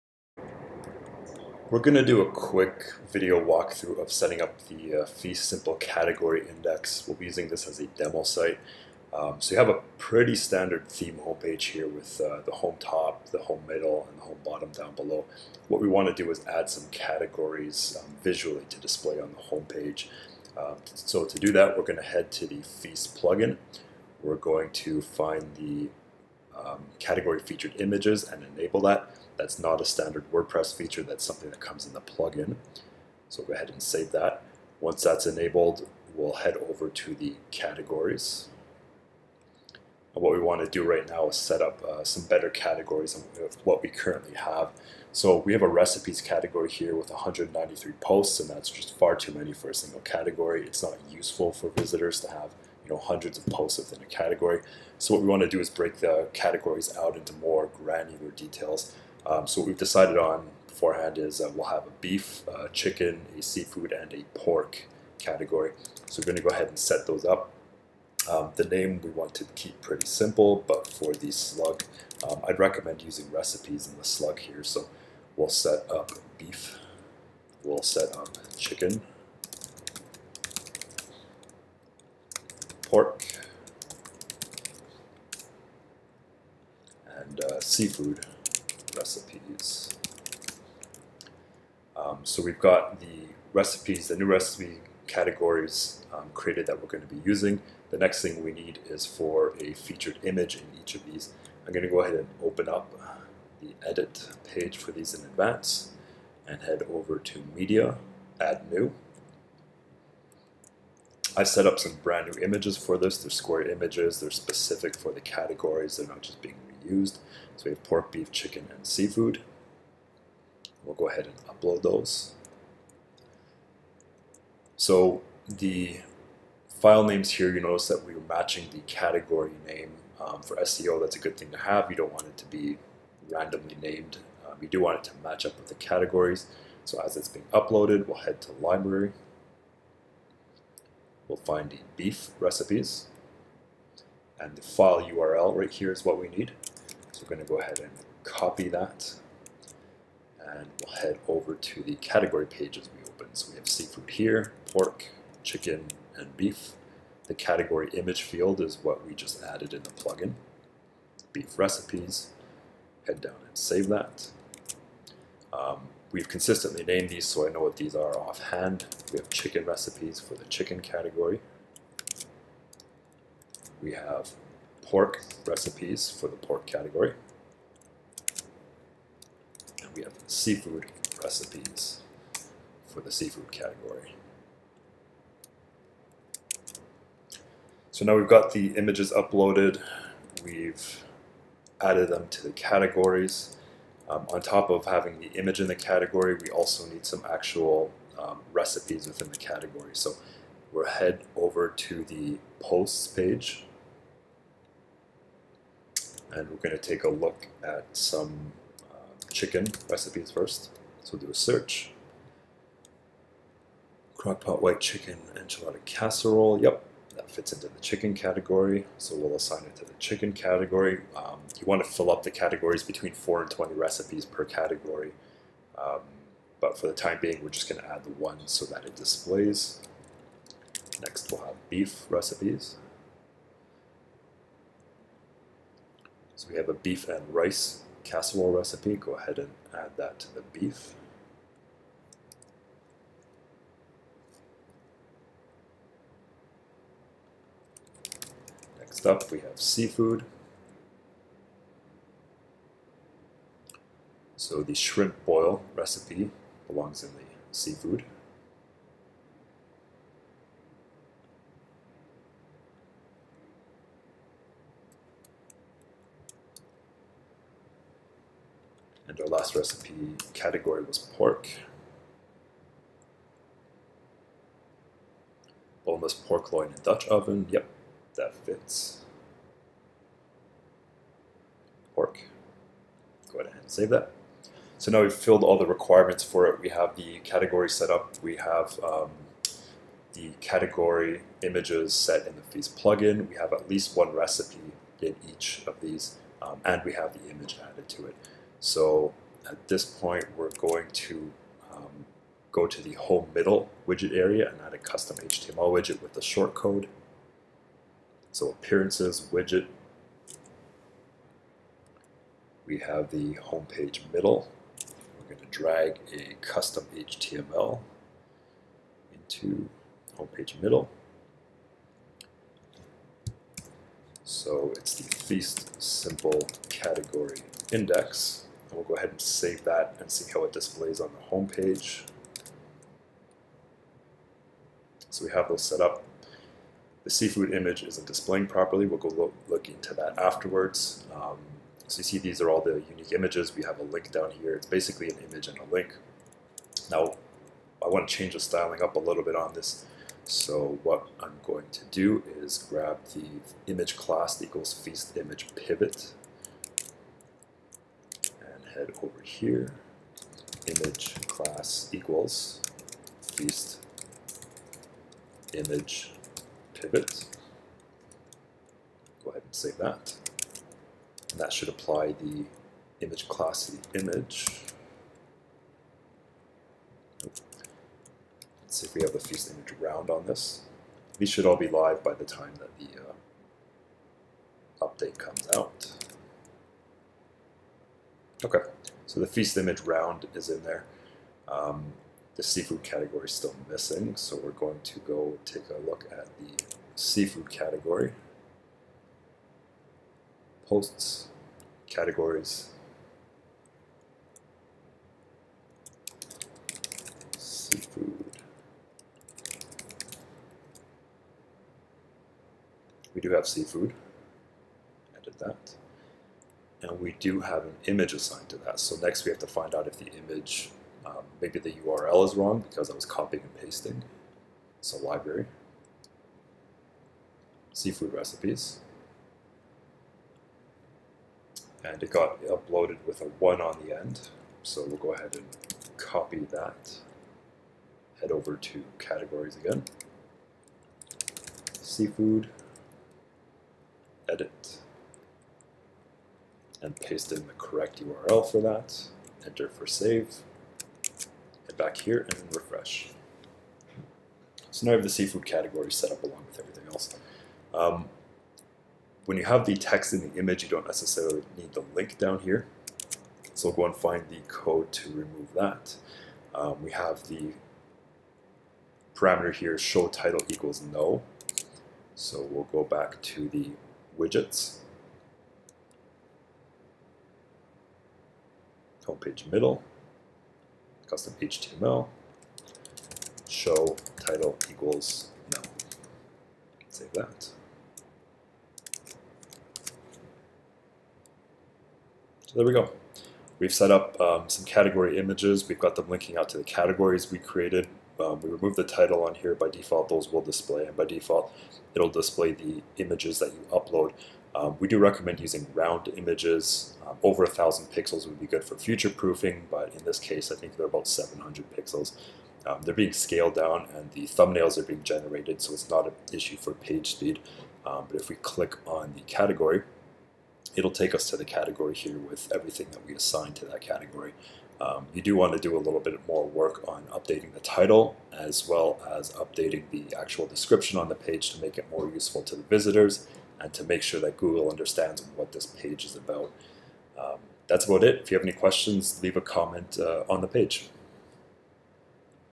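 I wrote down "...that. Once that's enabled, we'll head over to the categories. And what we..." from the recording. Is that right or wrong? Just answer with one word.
right.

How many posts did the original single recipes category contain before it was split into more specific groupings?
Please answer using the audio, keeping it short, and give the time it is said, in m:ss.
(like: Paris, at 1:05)
193, at 0:47.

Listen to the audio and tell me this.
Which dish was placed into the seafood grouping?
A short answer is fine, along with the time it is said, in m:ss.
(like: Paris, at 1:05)
shrimp boil, at 4:14.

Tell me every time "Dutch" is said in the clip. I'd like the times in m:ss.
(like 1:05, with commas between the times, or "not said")
4:36.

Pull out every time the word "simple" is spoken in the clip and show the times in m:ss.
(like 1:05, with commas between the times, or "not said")
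0:05, 1:10, 5:25.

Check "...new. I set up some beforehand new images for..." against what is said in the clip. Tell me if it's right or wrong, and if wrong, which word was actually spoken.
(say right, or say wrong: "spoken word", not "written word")
wrong: "brand", not "beforehand".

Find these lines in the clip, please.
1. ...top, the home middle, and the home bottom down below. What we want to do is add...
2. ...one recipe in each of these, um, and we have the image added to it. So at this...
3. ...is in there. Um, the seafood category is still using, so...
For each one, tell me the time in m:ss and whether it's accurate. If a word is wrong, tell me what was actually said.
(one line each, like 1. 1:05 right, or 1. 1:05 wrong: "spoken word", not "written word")
1. 0:12 right
2. 4:53 right
3. 6:30 wrong: "missing", not "using".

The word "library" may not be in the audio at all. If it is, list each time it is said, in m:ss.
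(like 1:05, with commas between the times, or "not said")
2:18, 7:04.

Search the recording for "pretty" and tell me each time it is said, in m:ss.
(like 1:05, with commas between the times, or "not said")
0:09, 1:09.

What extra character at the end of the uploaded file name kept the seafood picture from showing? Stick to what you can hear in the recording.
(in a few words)
1.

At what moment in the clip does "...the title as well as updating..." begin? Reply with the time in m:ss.
8:47.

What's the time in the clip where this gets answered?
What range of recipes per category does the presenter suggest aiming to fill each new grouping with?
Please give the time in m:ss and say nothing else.
3:42.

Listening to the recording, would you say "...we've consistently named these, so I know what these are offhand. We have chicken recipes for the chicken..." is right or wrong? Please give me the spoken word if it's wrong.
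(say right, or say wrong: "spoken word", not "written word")
right.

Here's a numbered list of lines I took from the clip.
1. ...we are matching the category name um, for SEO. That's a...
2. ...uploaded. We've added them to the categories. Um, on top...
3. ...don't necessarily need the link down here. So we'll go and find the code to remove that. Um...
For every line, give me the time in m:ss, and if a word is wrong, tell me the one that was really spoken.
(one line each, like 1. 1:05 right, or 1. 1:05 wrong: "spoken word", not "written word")
1. 2:08 right
2. 3:09 right
3. 7:40 right.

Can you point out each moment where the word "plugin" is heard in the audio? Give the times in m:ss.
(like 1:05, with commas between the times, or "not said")
0:23, 0:32, 2:39, 4:52.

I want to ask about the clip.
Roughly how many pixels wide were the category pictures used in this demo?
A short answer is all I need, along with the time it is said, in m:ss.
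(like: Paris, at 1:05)
700 pixels, at 8:31.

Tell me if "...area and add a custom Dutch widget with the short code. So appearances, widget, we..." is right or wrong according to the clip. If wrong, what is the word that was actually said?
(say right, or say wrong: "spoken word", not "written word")
wrong: "HTML", not "Dutch".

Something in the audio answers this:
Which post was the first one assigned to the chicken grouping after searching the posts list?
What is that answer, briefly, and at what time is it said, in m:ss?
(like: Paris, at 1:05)
Crockpot white chicken enchilada casserole, at 3:34.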